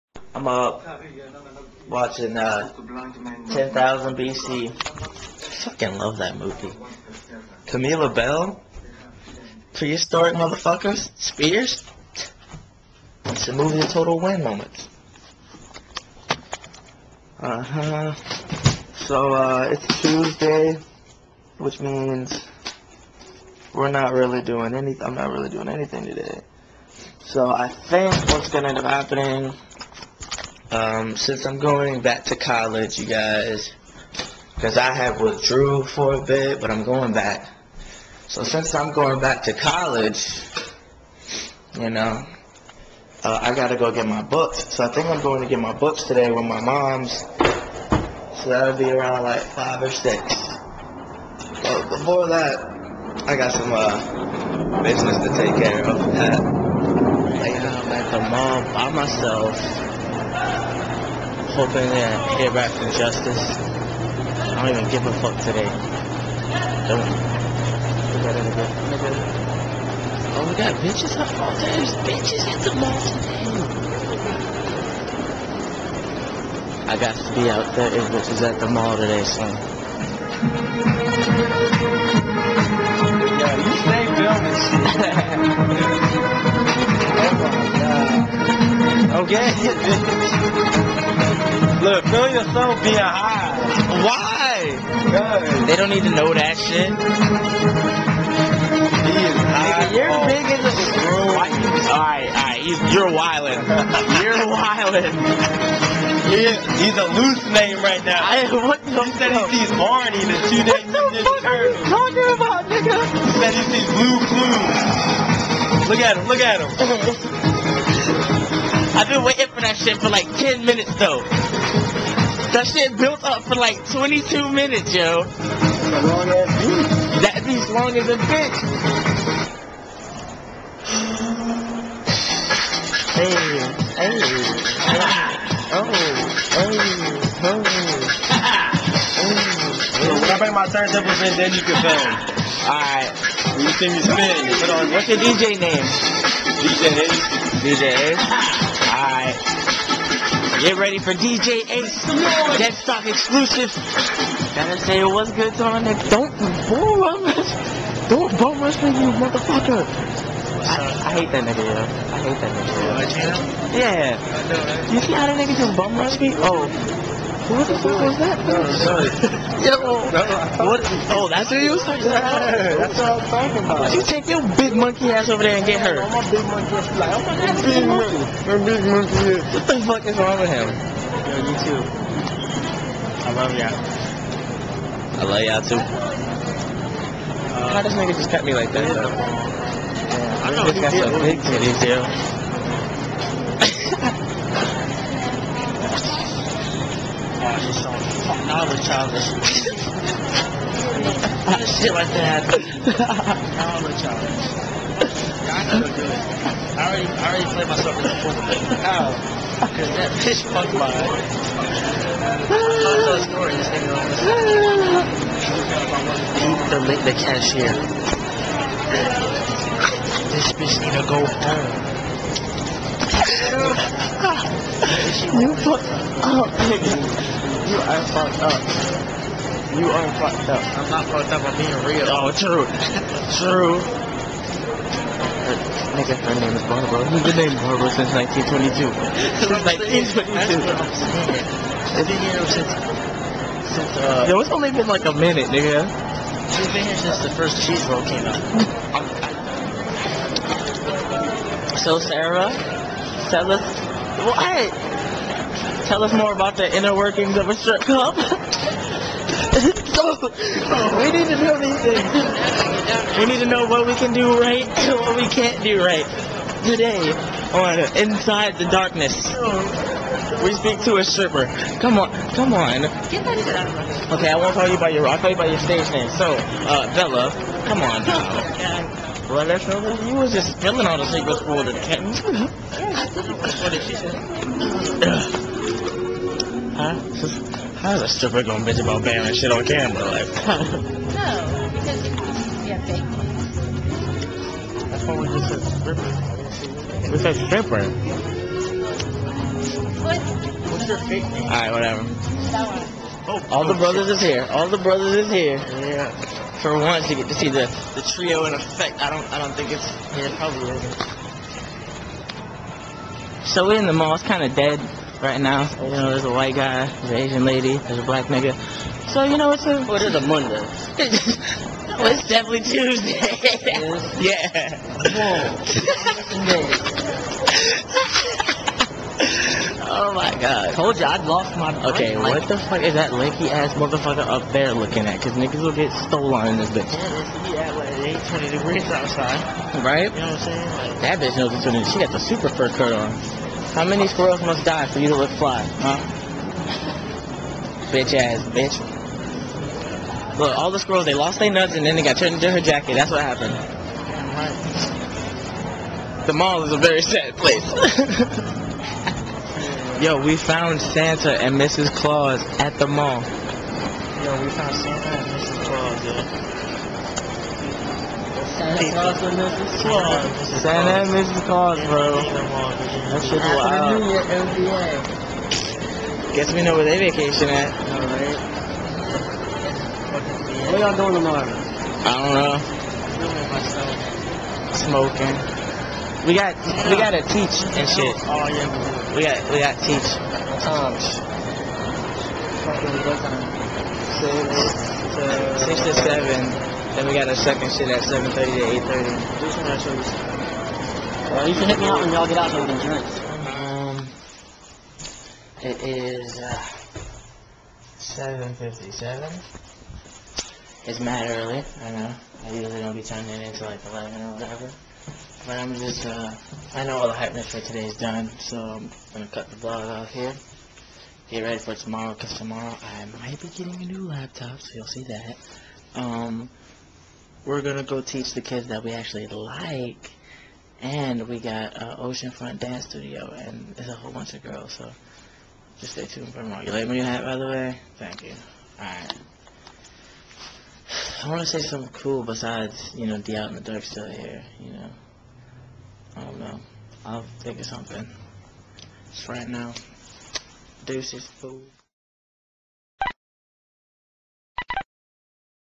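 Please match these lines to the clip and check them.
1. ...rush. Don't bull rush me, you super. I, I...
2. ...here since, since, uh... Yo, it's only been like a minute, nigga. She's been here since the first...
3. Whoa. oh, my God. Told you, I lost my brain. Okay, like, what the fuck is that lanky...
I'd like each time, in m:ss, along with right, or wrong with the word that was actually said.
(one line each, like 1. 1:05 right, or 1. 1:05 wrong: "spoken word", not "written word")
1. 2:36 wrong: "motherfucker", not "super"
2. 4:02 right
3. 5:29 right.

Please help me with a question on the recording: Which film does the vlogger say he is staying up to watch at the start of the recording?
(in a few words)
10,000 BC.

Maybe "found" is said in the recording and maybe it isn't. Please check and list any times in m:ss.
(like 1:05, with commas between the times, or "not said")
6:00, 6:04.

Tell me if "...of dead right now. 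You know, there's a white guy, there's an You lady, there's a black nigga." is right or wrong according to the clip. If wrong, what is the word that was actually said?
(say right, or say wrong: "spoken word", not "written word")
wrong: "Asian", not "You".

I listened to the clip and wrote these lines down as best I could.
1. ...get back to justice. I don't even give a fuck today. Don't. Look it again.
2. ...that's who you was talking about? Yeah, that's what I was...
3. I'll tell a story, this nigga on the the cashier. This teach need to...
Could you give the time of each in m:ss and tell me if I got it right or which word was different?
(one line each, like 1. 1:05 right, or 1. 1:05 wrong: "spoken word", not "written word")
1. 1:02 right
2. 2:51 right
3. 3:32 wrong: "bitch", not "teach".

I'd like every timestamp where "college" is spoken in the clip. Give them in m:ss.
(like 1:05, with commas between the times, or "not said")
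0:32, 0:39.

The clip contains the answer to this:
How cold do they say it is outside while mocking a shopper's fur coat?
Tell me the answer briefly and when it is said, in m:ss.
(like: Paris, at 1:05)
20 degrees, at 5:38.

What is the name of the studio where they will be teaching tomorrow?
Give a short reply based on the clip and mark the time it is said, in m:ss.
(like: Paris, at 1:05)
Oceanfront Dance Studio, at 7:11.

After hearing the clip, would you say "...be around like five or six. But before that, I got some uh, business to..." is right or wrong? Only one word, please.
right.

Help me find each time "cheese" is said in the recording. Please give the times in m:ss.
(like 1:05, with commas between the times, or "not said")
4:07.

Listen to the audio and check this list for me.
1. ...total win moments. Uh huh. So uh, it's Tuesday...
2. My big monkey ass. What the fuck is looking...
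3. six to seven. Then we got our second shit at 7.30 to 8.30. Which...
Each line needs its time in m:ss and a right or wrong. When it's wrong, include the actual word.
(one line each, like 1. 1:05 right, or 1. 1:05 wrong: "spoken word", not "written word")
1. 0:13 right
2. 2:58 wrong: "wrong", not "looking"
3. 6:35 right.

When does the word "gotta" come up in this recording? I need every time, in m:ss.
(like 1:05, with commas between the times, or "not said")
0:43, 2:34, 6:26.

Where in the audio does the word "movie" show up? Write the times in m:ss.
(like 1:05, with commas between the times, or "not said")
0:06, 0:13.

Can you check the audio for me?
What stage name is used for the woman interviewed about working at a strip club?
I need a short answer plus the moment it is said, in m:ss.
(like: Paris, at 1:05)
Bella, at 4:36.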